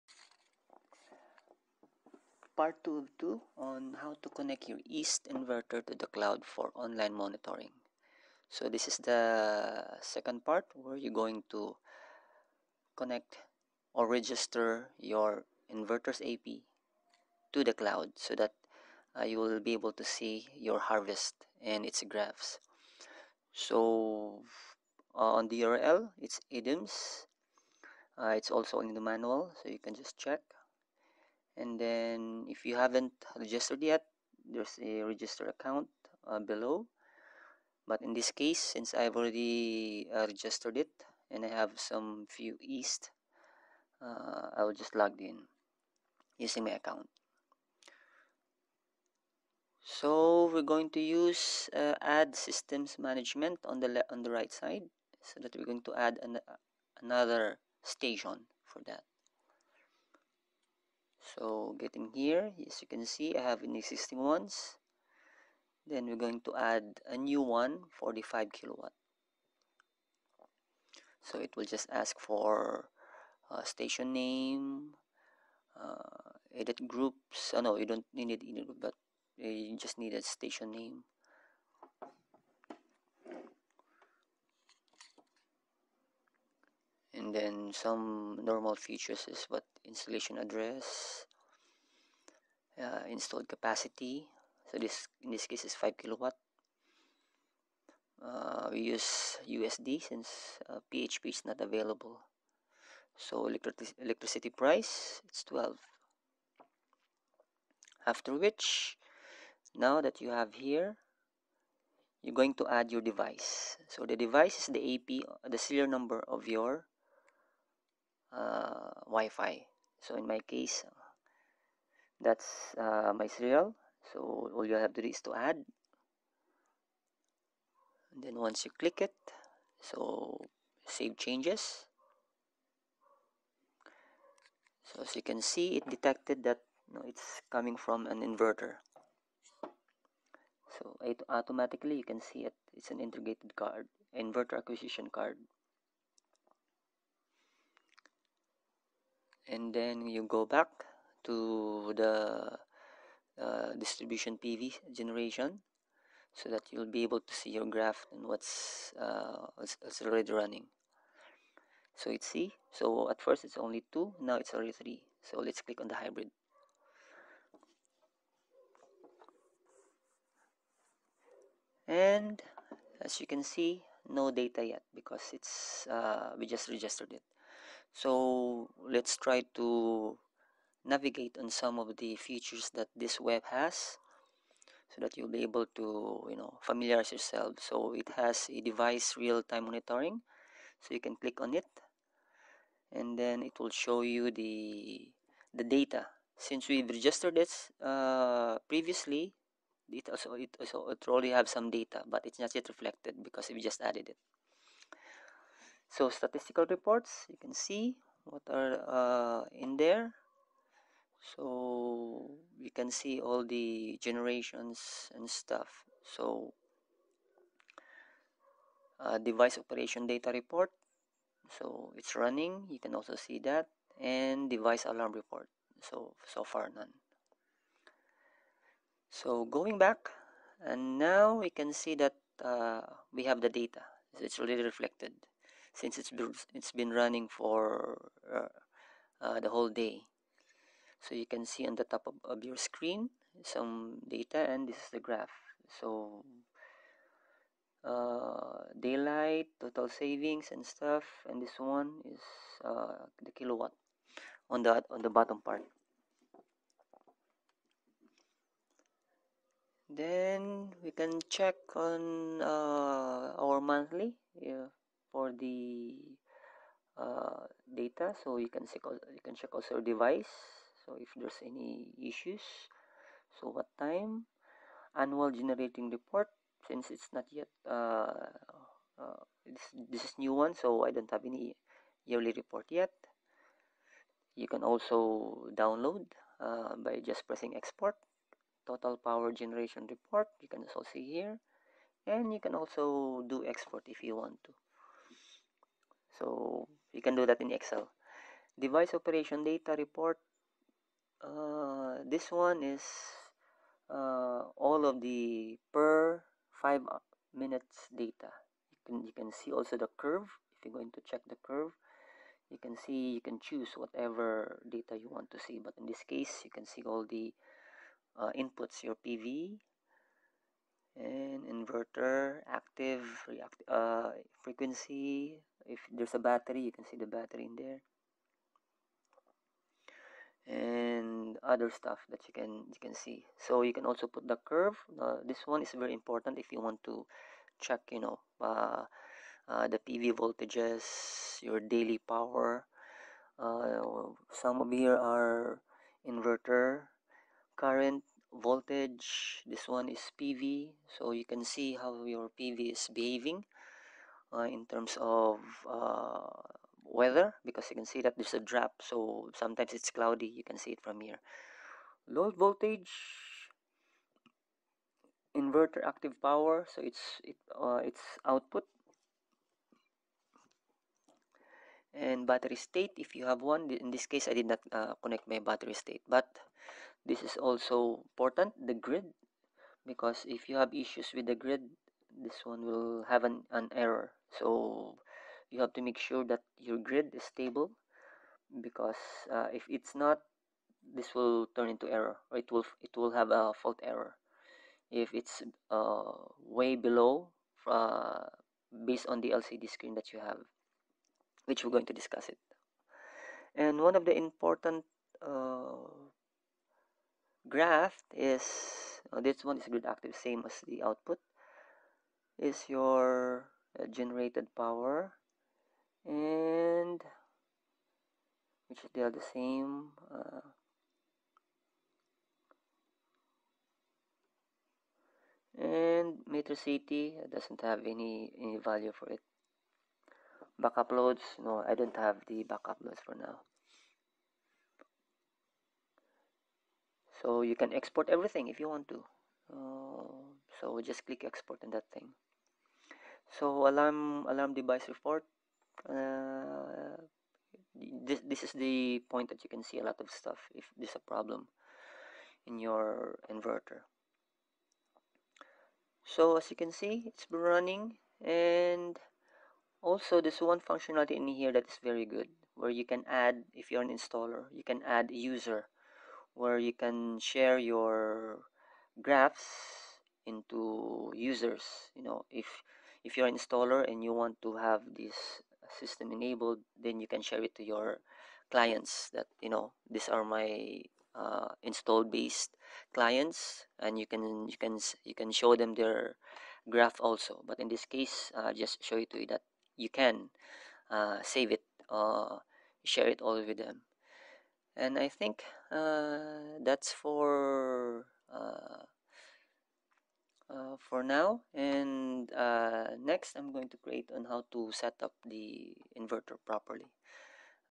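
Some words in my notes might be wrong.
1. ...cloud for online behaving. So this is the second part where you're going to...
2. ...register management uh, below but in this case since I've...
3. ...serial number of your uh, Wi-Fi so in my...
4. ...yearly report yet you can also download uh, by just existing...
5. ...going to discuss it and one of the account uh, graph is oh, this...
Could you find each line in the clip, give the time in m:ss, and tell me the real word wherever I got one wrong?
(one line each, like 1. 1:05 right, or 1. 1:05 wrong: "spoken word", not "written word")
1. 0:06 wrong: "monitoring", not "behaving"
2. 0:35 wrong: "account", not "management"
3. 1:55 right
4. 4:42 wrong: "pressing", not "existing"
5. 6:41 wrong: "important", not "account".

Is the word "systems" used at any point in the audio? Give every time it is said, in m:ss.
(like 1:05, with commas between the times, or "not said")
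0:52, 7:55.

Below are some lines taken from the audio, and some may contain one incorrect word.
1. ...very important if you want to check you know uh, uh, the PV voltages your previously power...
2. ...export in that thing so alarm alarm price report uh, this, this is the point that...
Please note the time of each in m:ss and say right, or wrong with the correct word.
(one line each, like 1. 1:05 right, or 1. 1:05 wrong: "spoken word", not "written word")
1. 5:35 wrong: "daily", not "previously"
2. 7:21 wrong: "device", not "price".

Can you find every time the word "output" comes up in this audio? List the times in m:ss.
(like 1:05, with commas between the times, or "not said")
6:08, 6:50.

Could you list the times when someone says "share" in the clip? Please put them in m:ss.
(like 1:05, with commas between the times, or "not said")
7:47, 7:57, 8:12.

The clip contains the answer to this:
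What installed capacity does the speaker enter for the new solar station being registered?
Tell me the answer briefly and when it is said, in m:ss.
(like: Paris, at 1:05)
5 kilowatt, at 1:35.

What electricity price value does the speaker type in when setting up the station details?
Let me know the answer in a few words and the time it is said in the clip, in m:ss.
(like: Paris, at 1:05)
12, at 1:45.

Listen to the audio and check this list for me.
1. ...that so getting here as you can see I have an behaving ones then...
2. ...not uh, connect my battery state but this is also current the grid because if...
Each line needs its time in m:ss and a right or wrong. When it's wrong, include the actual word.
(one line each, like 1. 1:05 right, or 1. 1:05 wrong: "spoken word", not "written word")
1. 0:58 wrong: "existing", not "behaving"
2. 6:14 wrong: "important", not "current".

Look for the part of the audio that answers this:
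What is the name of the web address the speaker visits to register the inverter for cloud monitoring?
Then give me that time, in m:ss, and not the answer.
0:26.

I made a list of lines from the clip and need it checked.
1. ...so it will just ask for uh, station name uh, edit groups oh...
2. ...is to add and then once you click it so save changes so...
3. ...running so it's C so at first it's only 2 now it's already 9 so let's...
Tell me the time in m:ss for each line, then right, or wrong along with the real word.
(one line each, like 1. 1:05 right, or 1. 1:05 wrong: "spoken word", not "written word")
1. 1:11 right
2. 2:05 right
3. 2:40 wrong: "3", not "9".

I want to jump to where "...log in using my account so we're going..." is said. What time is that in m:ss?
0:44.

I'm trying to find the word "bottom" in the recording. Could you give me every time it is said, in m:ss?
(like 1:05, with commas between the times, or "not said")
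4:15.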